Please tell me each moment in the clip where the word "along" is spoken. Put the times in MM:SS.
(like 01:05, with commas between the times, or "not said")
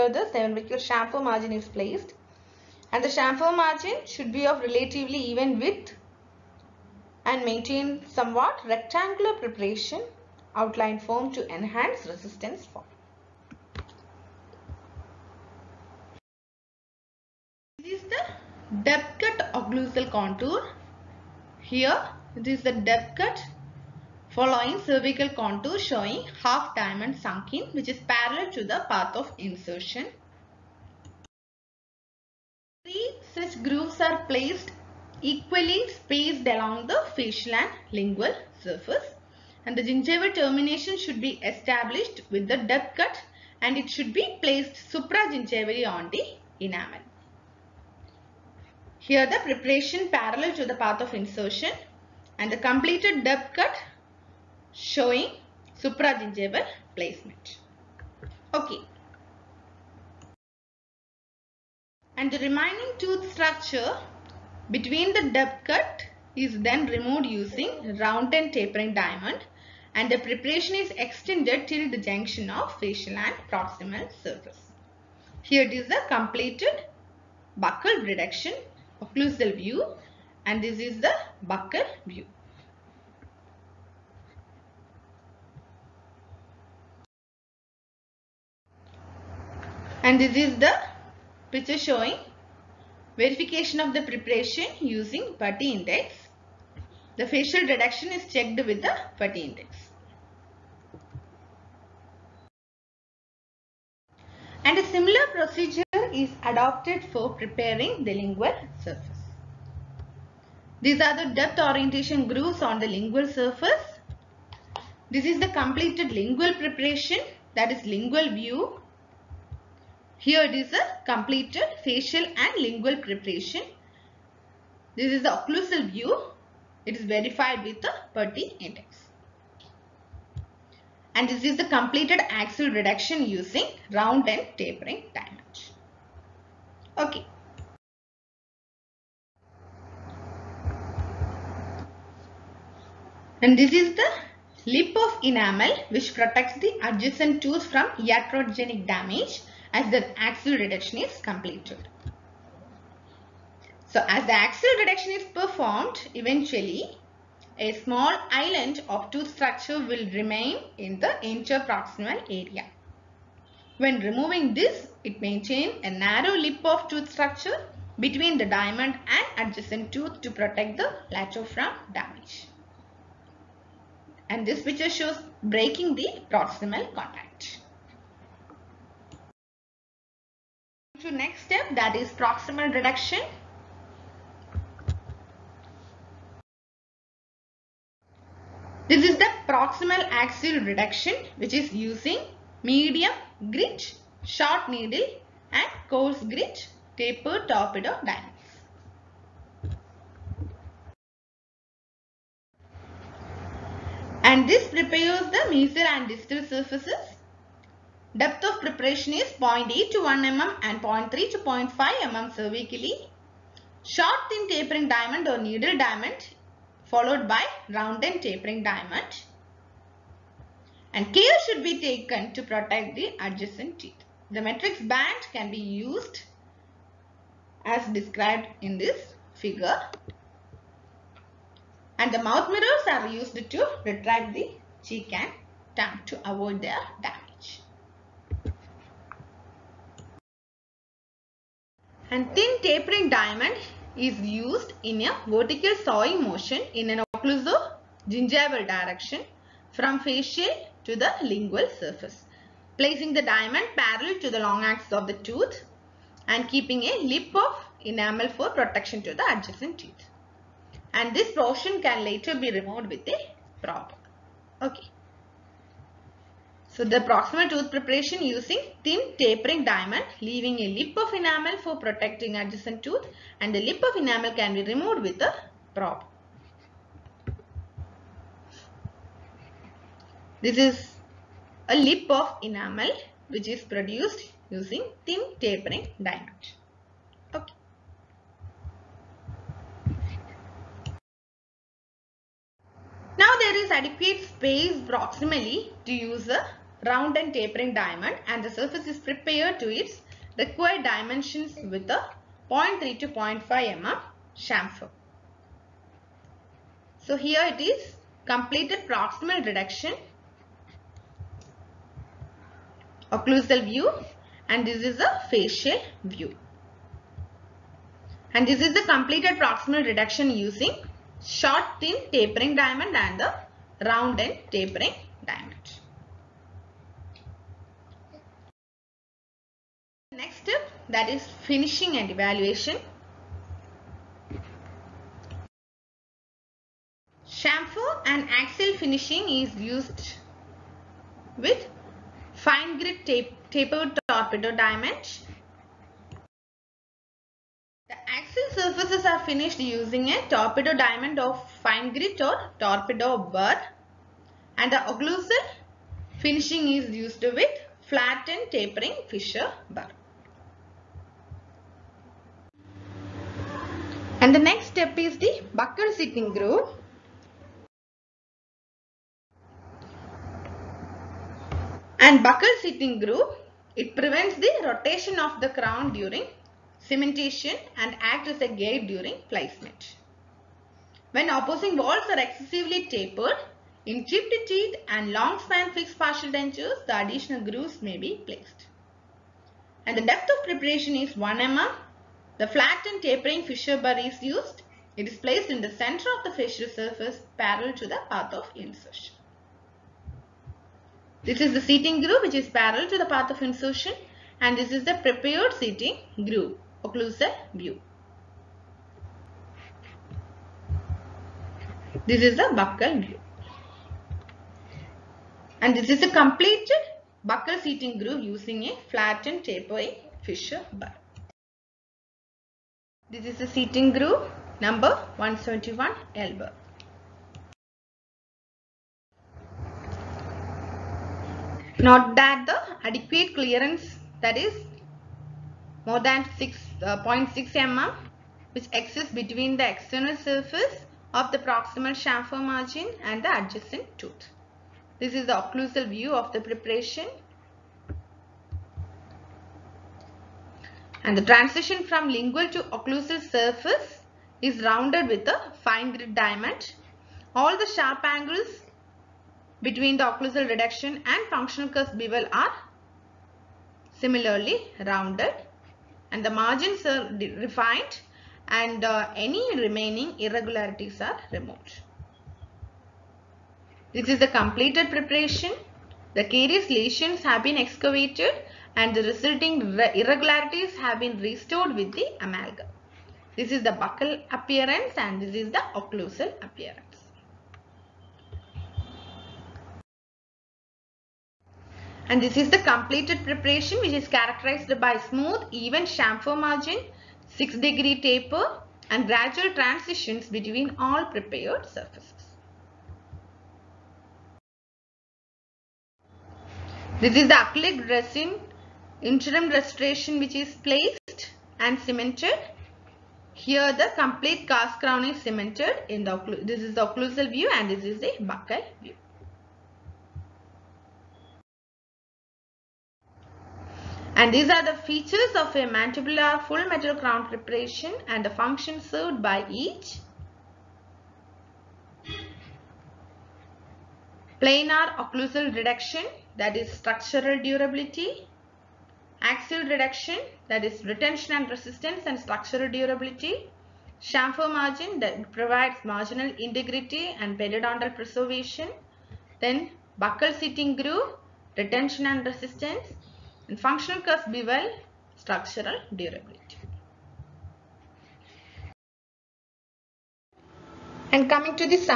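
00:36.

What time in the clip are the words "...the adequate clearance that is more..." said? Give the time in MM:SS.
07:12.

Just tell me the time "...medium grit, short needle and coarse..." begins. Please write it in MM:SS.
03:12.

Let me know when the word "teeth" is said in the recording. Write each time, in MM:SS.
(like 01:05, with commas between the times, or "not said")
03:43, 04:19, 06:24.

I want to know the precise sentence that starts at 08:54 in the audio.
Planar occlusal reduction that is structural durability axial reduction that is retention and resistance and structural durability.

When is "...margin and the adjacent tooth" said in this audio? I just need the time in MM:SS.
07:22.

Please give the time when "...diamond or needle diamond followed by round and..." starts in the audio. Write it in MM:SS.
03:34.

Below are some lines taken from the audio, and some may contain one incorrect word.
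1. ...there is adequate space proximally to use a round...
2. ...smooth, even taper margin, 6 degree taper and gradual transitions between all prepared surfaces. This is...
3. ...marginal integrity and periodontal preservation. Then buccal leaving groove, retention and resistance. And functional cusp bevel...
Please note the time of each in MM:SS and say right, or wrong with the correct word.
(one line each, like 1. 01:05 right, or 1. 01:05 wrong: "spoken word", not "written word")
1. 04:53 right
2. 08:14 wrong: "chamfer", not "taper"
3. 09:05 wrong: "seating", not "leaving".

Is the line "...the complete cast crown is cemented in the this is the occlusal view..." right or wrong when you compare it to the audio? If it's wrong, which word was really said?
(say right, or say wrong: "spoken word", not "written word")
right.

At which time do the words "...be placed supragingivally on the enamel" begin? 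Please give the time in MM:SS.
00:44.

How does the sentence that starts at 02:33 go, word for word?
So as the axial reduction is performed, eventually a small island of tooth structure will remain in the interproximal area.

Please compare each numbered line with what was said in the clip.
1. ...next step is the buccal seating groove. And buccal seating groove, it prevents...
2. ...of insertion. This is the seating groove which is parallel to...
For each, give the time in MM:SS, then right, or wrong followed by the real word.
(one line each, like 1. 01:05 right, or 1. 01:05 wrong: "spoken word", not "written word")
1. 06:04 right
2. 06:38 right.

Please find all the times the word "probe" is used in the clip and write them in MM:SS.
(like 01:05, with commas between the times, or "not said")
04:23, 04:35.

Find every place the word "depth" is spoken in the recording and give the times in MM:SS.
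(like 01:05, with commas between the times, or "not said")
00:18, 00:22, 00:42, 00:53, 01:05, 01:51, 03:28, 06:30.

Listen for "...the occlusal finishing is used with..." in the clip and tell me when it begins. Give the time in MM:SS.
05:54.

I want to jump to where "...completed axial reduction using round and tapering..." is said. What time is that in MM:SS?
02:11.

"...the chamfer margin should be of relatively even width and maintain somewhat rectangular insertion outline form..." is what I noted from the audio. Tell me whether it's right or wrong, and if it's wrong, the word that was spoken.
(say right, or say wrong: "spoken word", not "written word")
wrong: "preparation", not "insertion".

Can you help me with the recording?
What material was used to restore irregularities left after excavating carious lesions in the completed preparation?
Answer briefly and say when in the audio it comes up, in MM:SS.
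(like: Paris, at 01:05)
Amalgam, at 08:02.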